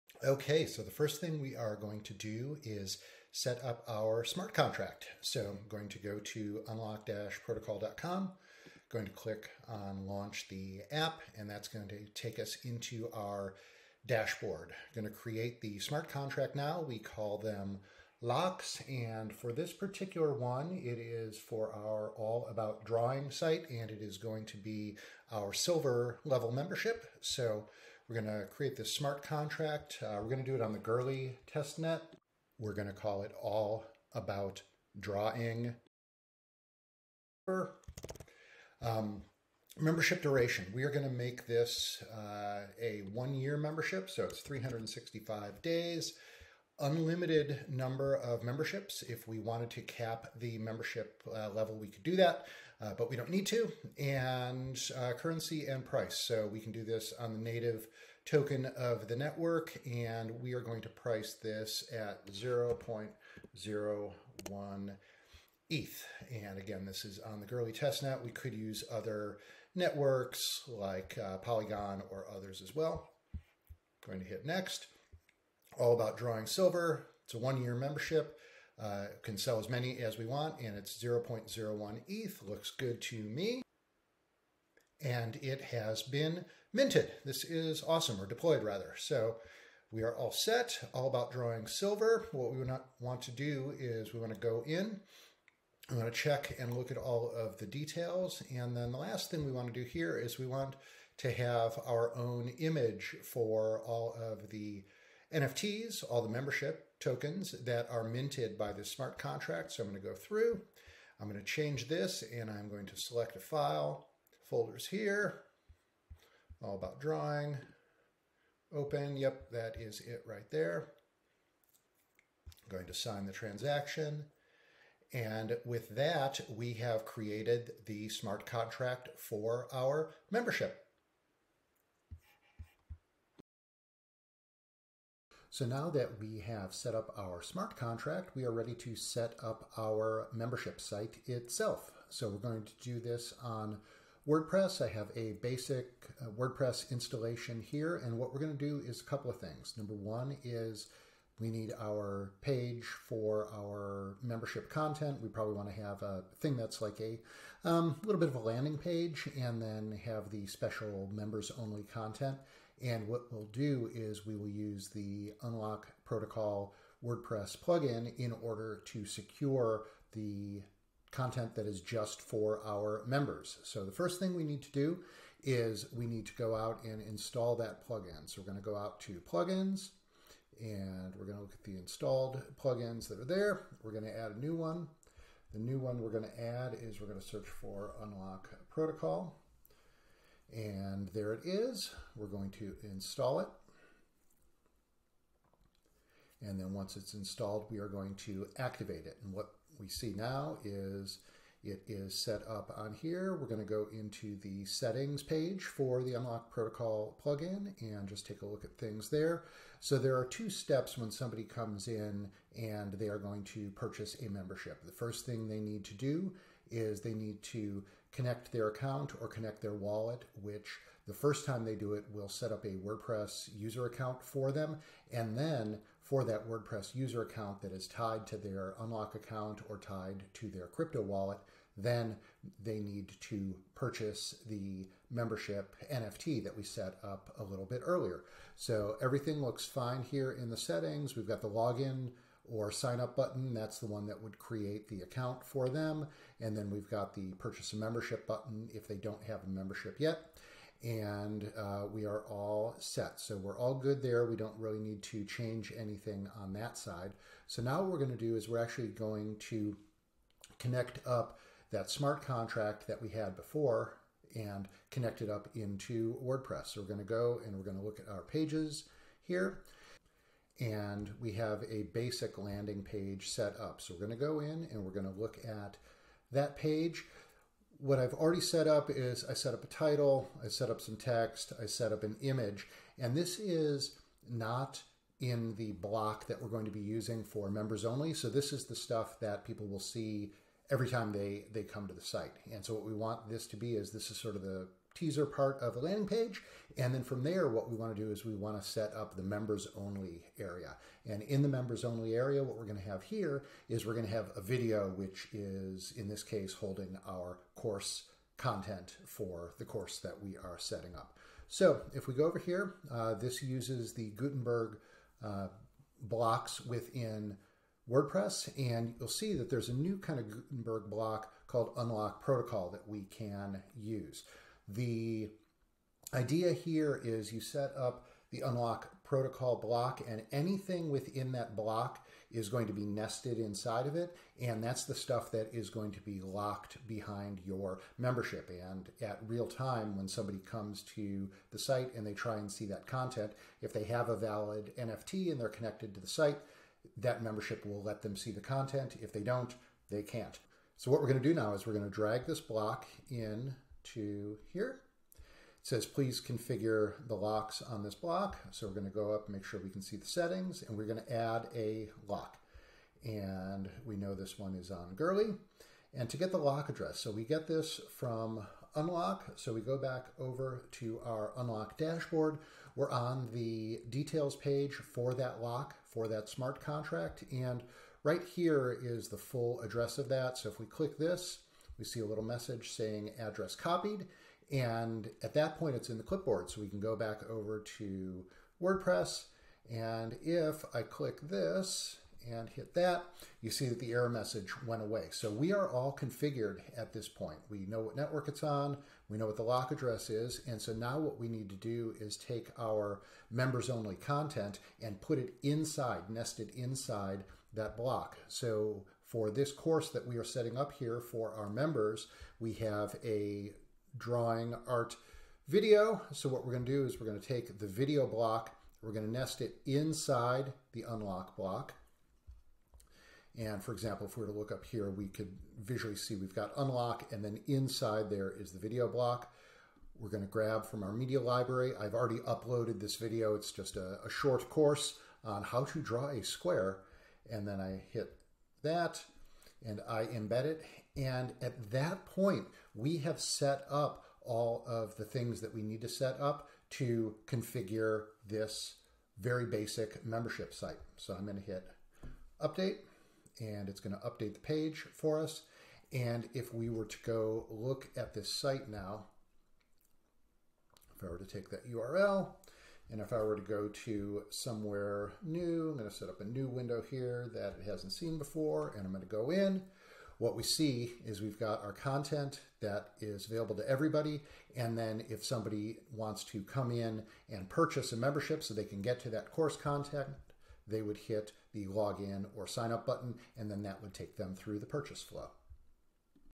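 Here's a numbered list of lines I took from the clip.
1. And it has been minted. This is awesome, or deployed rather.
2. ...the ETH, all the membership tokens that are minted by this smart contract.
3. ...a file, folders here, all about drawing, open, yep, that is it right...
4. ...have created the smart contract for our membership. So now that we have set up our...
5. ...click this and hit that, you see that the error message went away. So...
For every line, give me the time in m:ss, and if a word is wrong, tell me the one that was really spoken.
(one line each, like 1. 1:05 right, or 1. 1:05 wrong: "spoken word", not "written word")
1. 1:25 right
2. 1:44 wrong: "NFTs", not "ETH"
3. 1:53 right
4. 2:06 right
5. 6:30 right.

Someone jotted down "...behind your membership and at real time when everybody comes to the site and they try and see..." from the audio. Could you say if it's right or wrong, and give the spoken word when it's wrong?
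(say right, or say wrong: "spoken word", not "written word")
wrong: "somebody", not "everybody".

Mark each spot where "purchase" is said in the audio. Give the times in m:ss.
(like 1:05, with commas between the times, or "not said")
3:33, 3:53, 4:07, 7:57, 8:04.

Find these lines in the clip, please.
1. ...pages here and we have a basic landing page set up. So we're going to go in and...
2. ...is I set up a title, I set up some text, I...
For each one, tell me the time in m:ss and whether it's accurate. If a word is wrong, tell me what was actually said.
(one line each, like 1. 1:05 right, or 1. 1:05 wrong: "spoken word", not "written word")
1. 4:28 right
2. 4:38 right.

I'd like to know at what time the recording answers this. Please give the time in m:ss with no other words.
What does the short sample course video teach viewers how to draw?
7:16.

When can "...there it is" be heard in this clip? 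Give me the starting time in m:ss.
3:11.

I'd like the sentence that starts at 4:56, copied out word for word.
And then from there, what we want to do is we want to set up the members only area.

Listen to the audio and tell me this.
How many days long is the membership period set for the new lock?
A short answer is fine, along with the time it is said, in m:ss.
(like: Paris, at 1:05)
365, at 0:44.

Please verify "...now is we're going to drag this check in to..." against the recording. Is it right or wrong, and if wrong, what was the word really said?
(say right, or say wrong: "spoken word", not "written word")
wrong: "block", not "check".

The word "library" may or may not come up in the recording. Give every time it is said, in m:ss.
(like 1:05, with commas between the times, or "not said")
7:11.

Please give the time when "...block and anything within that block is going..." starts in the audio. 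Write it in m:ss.
5:29.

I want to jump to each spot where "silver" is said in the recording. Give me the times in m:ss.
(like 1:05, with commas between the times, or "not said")
0:25, 1:16, 1:31.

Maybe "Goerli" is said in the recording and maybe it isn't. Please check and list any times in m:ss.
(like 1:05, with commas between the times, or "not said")
0:30, 1:07, 6:04.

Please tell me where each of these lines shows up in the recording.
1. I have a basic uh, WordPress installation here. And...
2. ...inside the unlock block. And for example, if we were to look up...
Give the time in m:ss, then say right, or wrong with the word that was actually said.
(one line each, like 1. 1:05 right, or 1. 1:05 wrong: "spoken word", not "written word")
1. 2:24 right
2. 6:59 right.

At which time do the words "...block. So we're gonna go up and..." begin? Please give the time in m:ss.
5:57.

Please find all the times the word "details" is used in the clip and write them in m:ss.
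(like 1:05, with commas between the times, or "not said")
1:37, 6:13.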